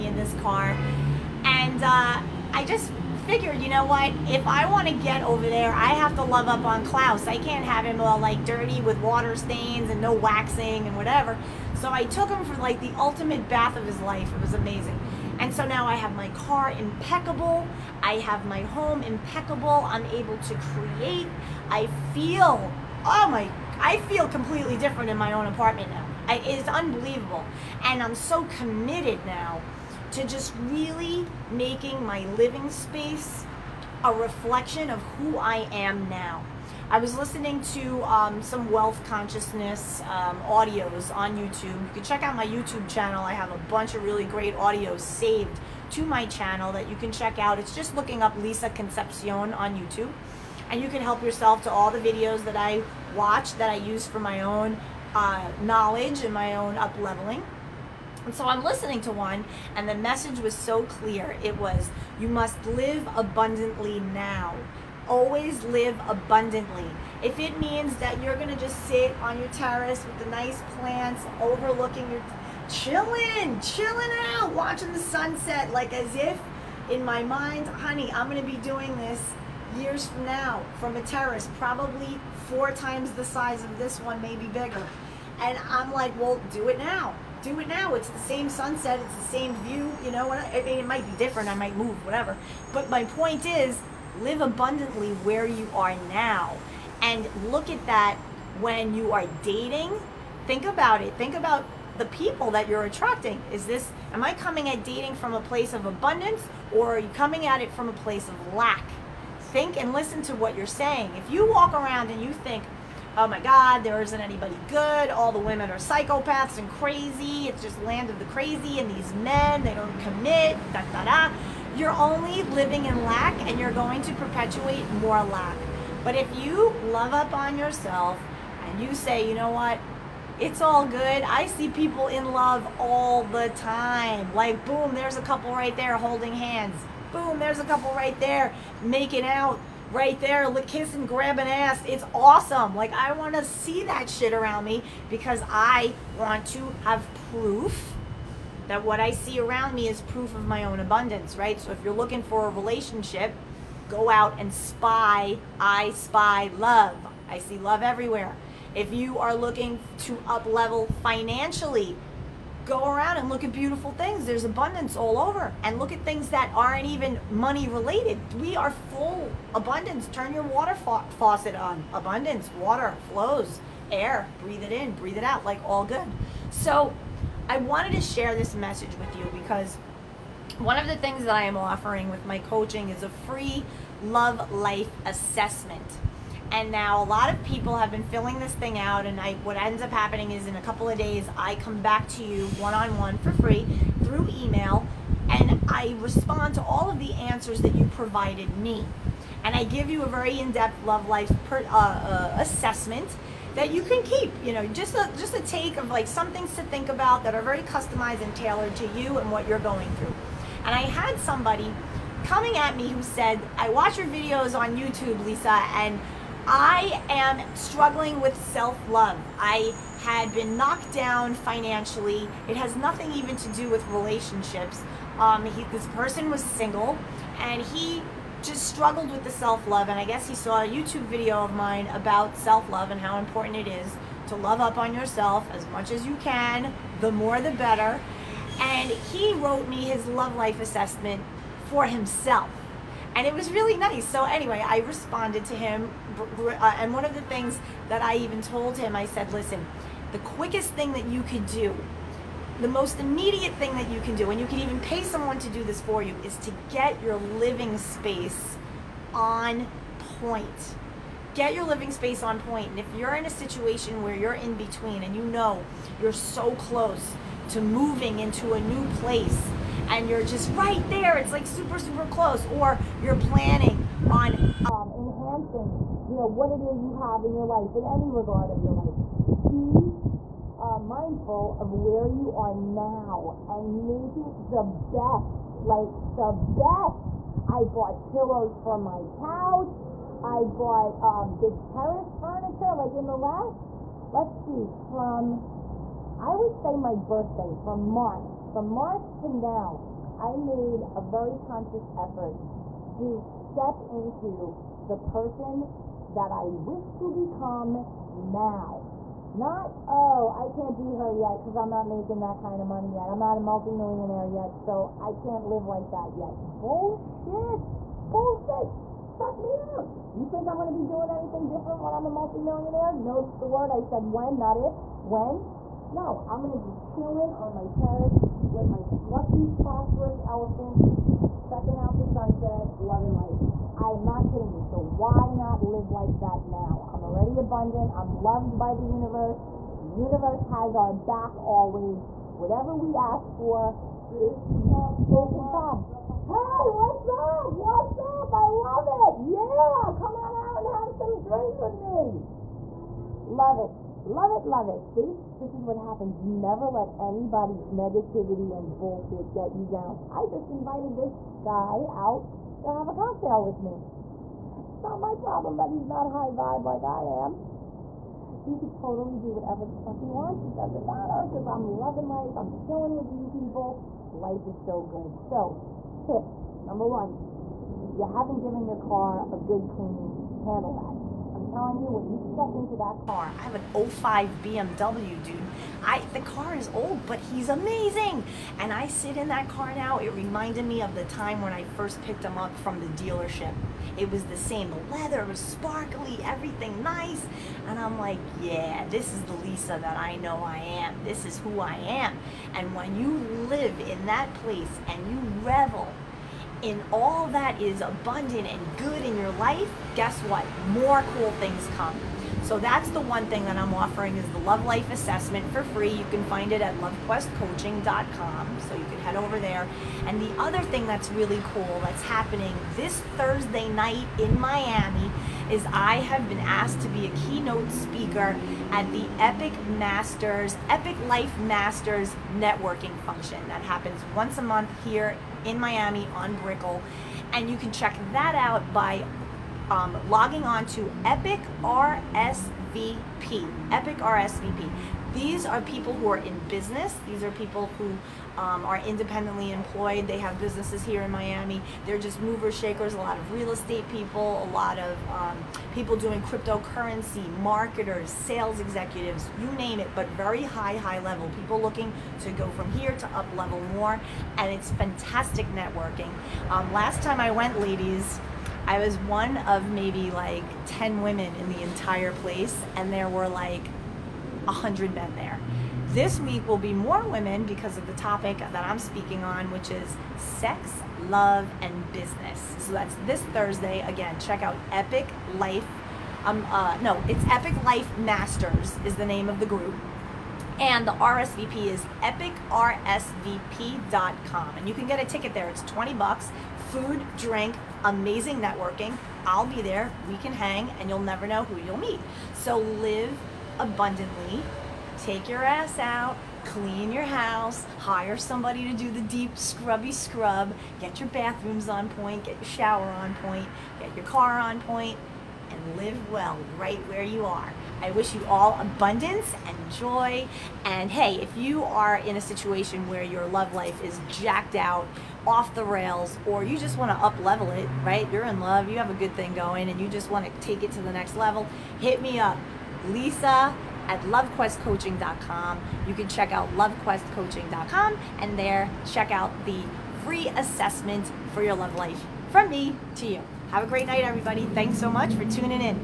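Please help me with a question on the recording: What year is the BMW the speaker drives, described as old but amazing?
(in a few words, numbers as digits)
05.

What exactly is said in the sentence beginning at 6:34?
leather, leather was sparkly, everything nice.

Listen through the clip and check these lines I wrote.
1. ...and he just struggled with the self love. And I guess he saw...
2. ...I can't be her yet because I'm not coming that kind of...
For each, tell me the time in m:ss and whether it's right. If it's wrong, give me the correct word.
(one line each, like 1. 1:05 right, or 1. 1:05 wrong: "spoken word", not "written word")
1. 3:47 right
2. 5:10 wrong: "making", not "coming".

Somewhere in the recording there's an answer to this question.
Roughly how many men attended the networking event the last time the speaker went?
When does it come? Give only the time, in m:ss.
7:54.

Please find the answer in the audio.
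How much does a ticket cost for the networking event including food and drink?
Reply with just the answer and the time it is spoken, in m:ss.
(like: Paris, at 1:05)
$20, at 8:15.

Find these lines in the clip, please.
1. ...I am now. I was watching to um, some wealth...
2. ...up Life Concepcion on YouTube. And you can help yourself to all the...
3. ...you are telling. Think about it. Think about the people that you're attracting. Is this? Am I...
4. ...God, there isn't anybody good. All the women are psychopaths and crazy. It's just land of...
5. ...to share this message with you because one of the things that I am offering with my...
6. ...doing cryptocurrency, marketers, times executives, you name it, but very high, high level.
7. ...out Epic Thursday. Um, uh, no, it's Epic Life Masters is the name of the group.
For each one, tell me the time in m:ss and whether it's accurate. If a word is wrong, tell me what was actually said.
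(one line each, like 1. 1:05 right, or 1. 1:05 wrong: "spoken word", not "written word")
1. 0:35 wrong: "listening", not "watching"
2. 0:48 wrong: "Lisa", not "Life"
3. 1:38 wrong: "dating", not "telling"
4. 1:53 right
5. 2:57 right
6. 7:35 wrong: "sales", not "times"
7. 8:04 wrong: "Life", not "Thursday".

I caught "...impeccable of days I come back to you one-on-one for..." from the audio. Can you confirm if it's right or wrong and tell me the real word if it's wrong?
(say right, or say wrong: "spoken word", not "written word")
wrong: "couple", not "impeccable".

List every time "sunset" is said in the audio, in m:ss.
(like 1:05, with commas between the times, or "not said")
1:14, 1:28, 5:32.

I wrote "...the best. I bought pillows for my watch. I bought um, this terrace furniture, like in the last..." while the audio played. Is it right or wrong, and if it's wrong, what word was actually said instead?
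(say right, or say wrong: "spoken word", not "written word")
wrong: "couch", not "watch".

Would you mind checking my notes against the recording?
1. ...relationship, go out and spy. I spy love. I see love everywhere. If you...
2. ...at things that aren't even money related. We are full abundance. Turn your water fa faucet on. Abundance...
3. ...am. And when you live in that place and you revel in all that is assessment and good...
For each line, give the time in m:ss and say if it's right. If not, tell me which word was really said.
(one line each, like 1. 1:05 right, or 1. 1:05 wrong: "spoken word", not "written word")
1. 2:32 right
2. 2:45 right
3. 6:41 wrong: "abundant", not "assessment".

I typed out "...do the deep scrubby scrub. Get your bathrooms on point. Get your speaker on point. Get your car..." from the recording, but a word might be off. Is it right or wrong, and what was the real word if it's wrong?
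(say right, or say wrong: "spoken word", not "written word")
wrong: "shower", not "speaker".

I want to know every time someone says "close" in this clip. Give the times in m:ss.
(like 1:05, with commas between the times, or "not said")
4:26, 4:32.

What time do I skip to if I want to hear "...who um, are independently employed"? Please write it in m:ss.
7:27.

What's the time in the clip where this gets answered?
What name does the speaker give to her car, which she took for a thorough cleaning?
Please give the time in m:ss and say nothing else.
0:06.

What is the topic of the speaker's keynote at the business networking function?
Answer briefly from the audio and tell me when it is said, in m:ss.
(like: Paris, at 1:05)
Sex, love, and business, at 8:00.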